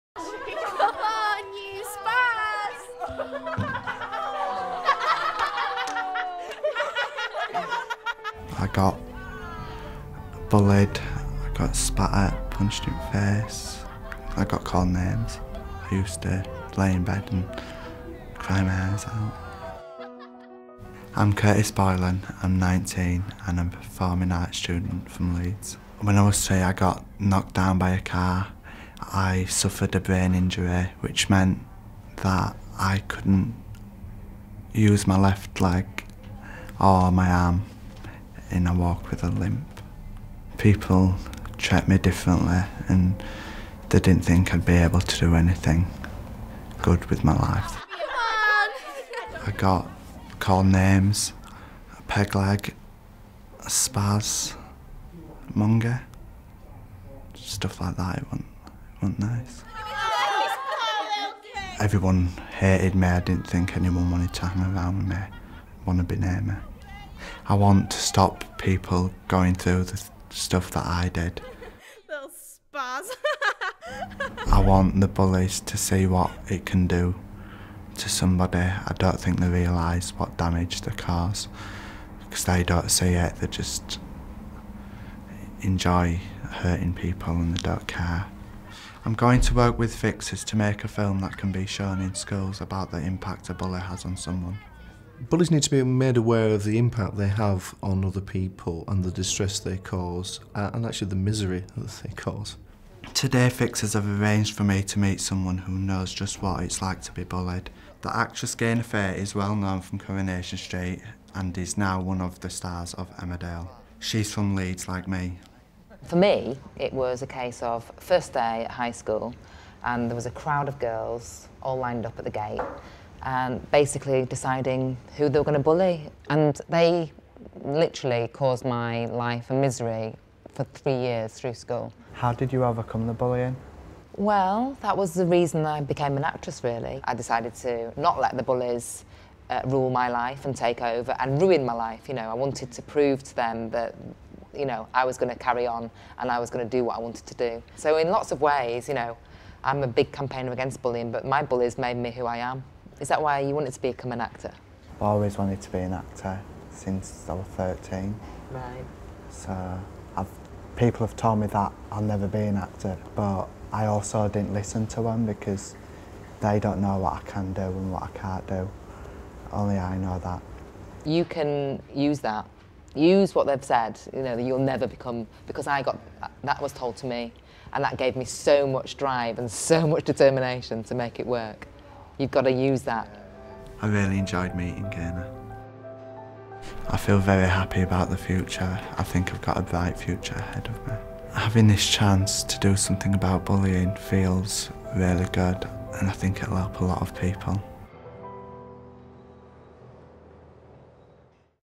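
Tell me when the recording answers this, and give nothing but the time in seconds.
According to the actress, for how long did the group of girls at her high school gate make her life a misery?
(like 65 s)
130 s.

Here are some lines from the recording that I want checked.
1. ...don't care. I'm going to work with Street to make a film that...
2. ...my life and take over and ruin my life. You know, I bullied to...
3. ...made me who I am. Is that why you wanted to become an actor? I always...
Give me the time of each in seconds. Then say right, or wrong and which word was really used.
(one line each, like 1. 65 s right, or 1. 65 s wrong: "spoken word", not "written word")
1. 87 s wrong: "Fixers", not "Street"
2. 139 s wrong: "wanted", not "bullied"
3. 151 s right.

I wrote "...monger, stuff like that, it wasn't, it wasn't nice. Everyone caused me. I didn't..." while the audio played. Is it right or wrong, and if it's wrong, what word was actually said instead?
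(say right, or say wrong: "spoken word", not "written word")
wrong: "hated", not "caused".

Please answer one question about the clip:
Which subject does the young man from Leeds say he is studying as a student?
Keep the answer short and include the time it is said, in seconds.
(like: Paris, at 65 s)
Performing arts, at 23 s.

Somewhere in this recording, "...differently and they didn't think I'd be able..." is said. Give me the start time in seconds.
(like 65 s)
41 s.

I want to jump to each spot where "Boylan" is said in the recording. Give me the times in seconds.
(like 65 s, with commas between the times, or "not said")
21 s.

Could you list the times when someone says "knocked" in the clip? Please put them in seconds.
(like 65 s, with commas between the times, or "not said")
27 s.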